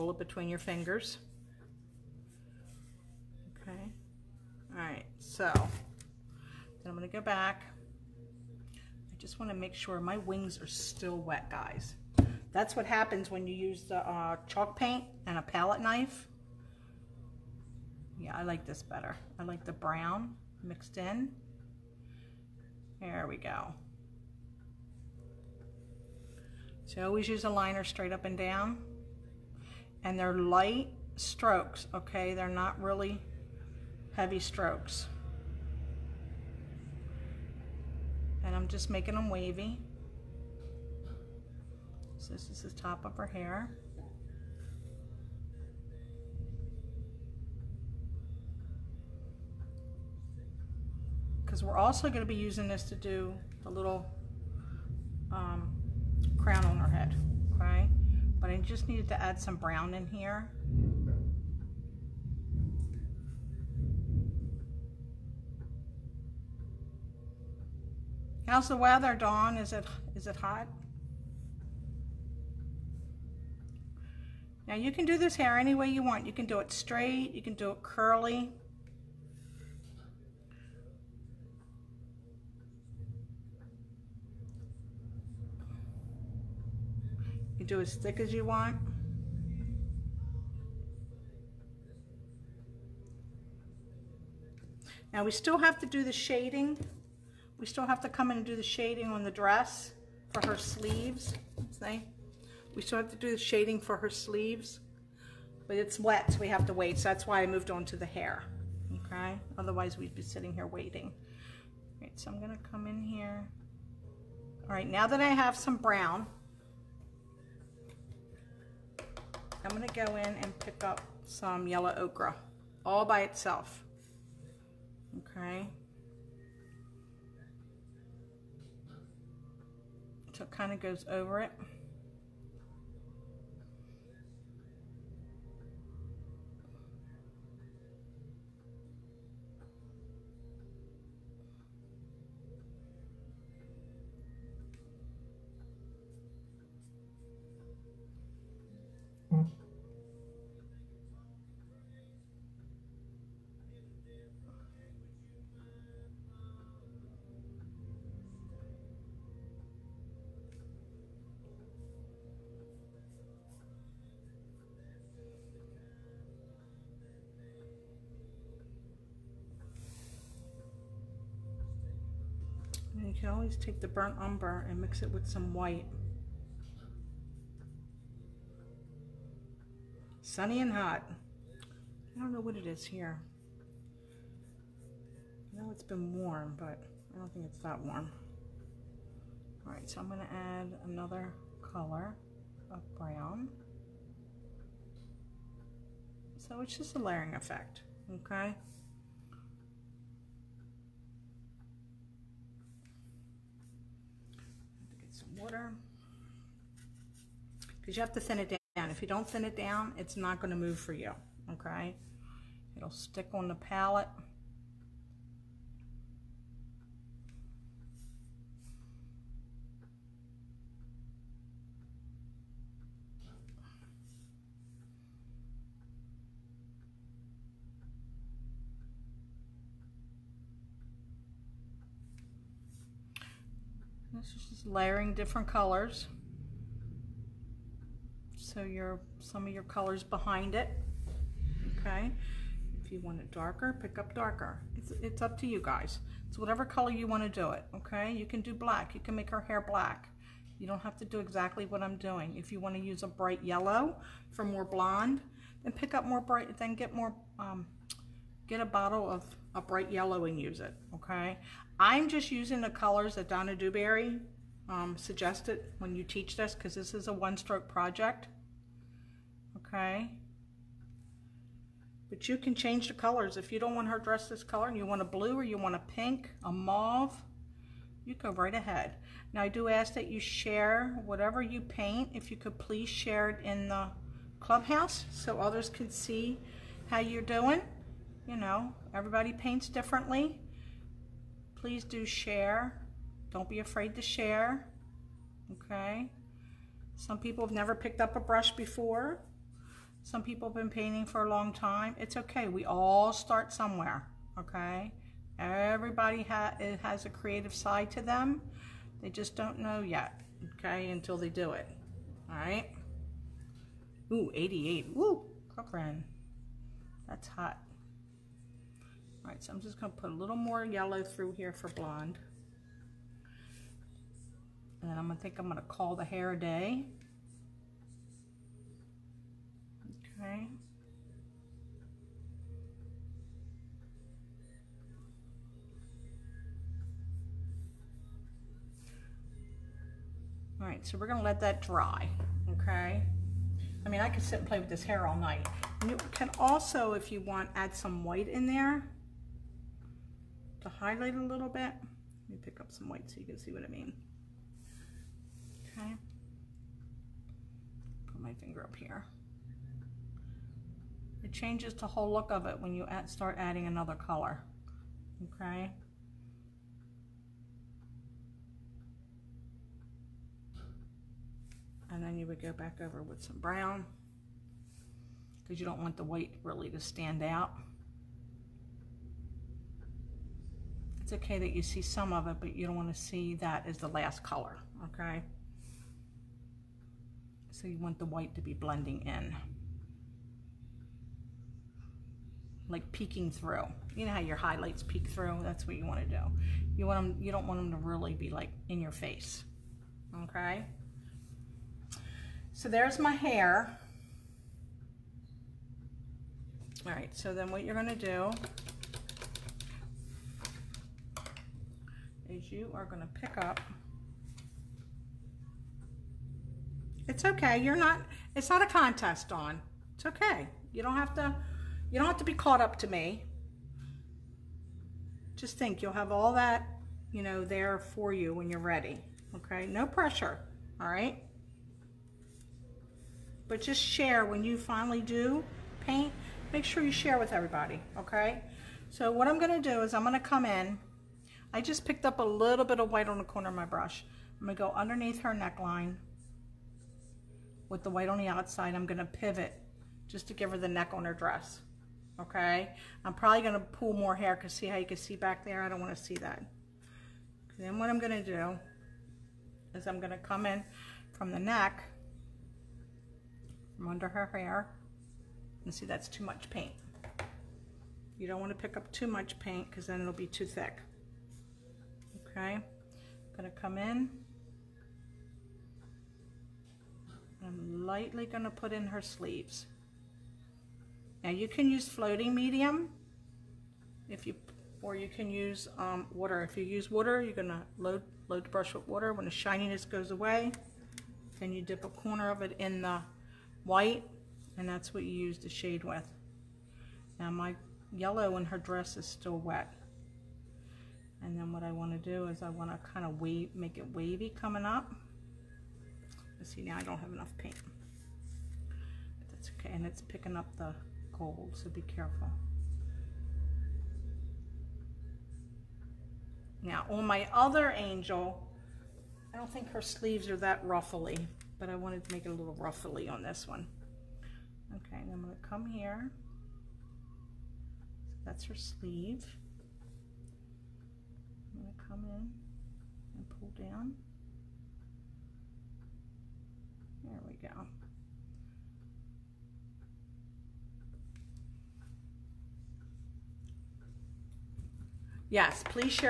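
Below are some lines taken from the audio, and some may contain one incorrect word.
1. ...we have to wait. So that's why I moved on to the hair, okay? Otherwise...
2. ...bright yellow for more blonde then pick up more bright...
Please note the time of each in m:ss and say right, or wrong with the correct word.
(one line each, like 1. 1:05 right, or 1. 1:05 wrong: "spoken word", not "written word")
1. 1:46 right
2. 4:13 right.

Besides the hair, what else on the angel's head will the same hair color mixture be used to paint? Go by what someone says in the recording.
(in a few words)
Crown.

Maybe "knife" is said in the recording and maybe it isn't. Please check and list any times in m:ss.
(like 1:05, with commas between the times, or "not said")
0:15.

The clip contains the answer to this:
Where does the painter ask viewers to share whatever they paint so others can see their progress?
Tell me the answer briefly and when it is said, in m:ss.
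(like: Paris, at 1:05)
The clubhouse, at 4:44.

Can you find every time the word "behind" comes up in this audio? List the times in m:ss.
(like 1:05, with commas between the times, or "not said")
4:00.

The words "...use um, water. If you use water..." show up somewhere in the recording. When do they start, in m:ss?
8:05.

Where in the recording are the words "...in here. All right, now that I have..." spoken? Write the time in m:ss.
1:52.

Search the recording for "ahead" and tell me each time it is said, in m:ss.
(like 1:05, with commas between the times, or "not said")
4:38.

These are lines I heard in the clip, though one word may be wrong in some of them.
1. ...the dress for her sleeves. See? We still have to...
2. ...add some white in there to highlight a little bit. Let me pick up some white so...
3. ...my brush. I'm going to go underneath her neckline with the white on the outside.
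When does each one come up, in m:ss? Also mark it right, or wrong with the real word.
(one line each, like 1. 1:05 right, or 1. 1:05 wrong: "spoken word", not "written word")
1. 1:39 right
2. 5:47 right
3. 7:23 right.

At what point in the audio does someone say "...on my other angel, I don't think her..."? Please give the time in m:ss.
8:36.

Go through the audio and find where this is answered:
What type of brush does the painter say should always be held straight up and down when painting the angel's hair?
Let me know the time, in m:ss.
0:27.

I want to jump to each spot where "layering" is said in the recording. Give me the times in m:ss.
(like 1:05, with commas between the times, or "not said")
3:16, 3:54.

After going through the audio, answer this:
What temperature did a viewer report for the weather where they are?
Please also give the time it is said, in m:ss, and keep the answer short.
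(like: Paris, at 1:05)
88, at 5:14.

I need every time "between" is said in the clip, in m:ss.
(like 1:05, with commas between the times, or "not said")
0:00.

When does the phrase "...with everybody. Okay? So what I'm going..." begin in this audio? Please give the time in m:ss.
7:17.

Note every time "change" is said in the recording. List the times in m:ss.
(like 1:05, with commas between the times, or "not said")
4:32, 6:01.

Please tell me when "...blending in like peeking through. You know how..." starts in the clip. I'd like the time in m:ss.
6:28.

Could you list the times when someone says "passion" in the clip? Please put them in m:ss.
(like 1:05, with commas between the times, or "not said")
not said.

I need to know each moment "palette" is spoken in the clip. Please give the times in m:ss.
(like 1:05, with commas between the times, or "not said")
0:15, 3:33.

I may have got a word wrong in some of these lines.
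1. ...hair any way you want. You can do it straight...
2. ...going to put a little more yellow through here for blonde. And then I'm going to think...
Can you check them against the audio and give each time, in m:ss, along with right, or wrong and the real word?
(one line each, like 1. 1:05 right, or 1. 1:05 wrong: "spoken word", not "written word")
1. 1:15 right
2. 5:19 right.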